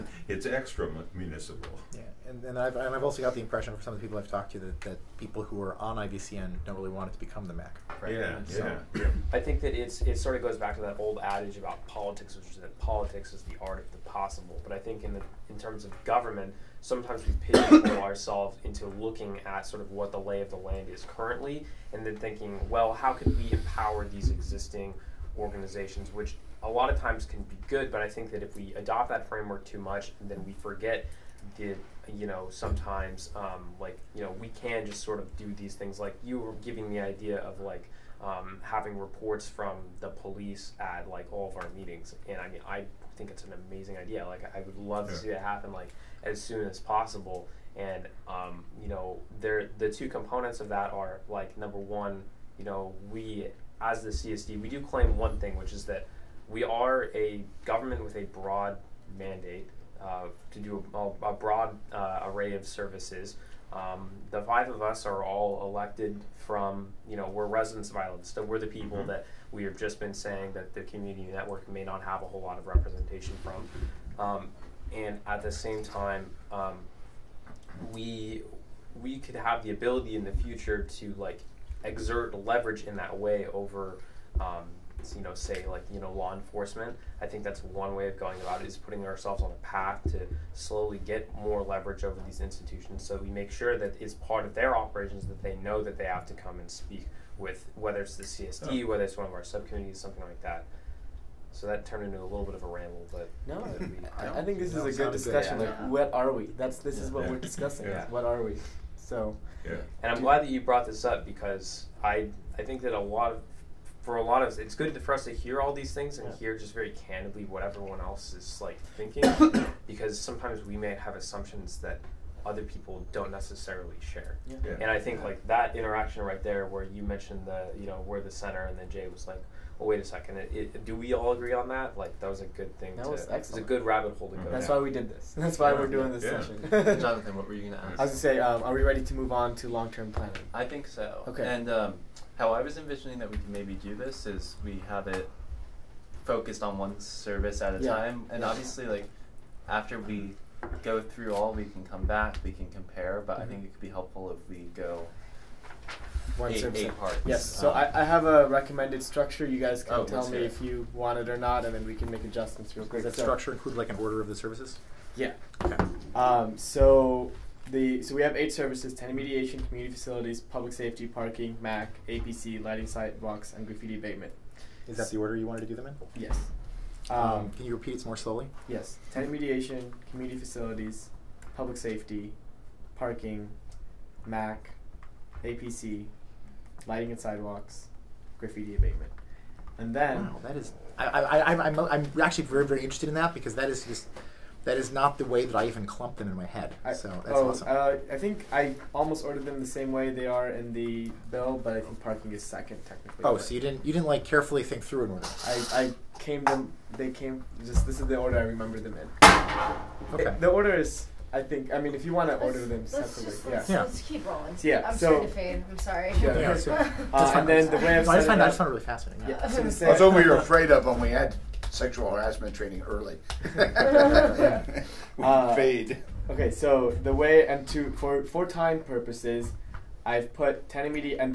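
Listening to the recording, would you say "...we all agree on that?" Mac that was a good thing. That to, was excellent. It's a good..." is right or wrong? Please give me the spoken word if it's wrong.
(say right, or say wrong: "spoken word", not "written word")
wrong: "Like", not "Mac".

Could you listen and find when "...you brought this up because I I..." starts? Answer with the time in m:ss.
1:50.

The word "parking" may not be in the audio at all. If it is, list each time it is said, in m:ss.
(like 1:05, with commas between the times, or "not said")
2:51, 3:02, 3:22.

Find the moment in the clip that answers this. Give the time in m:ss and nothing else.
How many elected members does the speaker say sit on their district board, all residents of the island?
1:04.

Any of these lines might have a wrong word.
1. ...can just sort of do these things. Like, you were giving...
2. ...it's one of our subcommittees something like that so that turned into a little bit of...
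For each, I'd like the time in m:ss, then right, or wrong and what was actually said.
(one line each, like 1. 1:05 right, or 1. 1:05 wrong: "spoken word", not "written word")
1. 0:34 right
2. 1:39 right.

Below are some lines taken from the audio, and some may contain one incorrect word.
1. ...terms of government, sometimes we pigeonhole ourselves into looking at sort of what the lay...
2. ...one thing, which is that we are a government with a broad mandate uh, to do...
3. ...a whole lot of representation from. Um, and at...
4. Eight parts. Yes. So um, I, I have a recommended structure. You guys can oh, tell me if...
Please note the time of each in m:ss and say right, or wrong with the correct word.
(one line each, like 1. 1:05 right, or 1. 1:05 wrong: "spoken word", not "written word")
1. 0:15 right
2. 0:55 right
3. 1:12 right
4. 2:36 right.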